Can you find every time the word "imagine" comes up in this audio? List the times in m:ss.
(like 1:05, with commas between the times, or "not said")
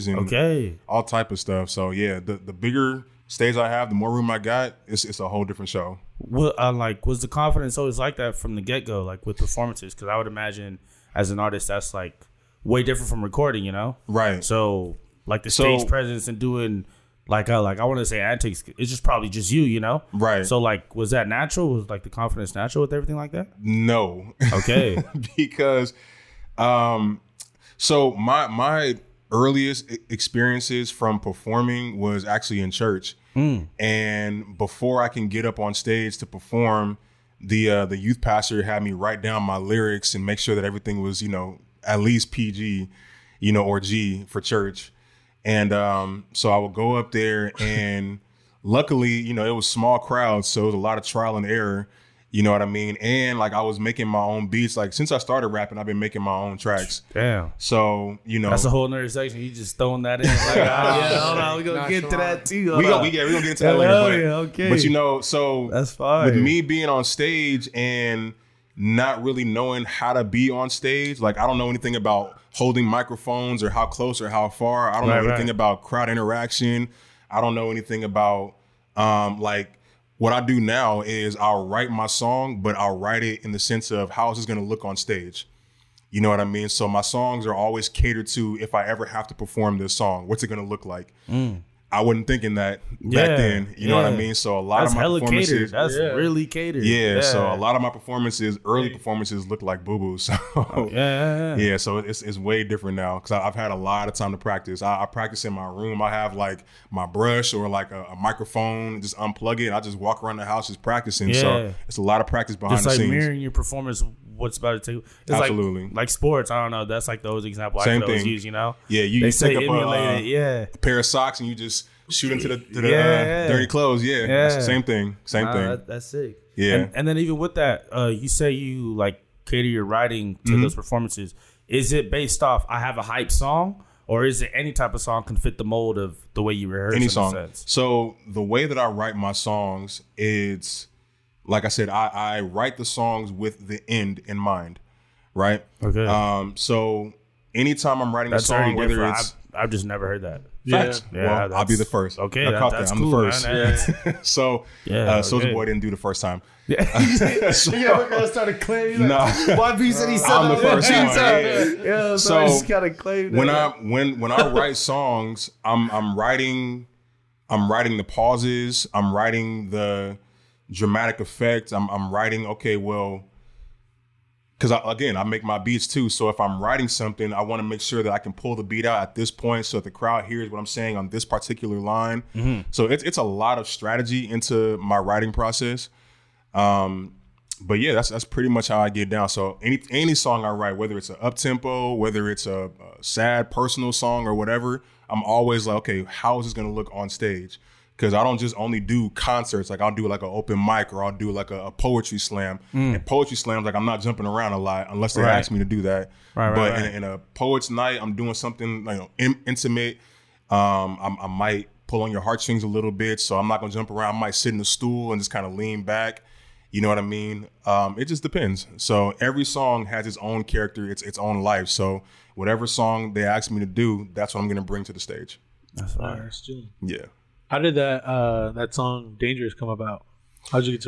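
0:10.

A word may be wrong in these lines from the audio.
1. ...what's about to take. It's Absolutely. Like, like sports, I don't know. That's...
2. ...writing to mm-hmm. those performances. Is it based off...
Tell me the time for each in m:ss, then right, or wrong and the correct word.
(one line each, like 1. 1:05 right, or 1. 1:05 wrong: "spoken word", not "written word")
1. 1:54 right
2. 2:09 right.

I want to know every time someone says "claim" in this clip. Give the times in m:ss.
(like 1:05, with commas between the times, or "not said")
2:38, 2:42.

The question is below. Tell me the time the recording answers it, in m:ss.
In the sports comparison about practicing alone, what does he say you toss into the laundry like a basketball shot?
2:00.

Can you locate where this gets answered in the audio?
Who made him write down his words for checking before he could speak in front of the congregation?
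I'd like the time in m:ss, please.
0:37.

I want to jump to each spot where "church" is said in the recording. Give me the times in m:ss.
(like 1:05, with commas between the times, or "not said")
0:32, 0:44.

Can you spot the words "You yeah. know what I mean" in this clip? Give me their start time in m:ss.
1:33.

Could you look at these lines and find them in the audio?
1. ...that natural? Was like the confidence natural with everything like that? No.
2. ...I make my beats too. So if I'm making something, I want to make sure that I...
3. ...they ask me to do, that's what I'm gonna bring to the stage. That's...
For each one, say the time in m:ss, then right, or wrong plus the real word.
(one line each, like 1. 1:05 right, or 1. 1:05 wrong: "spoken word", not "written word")
1. 0:21 right
2. 2:55 wrong: "writing", not "making"
3. 3:43 right.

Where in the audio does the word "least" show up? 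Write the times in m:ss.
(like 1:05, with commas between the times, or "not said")
0:42.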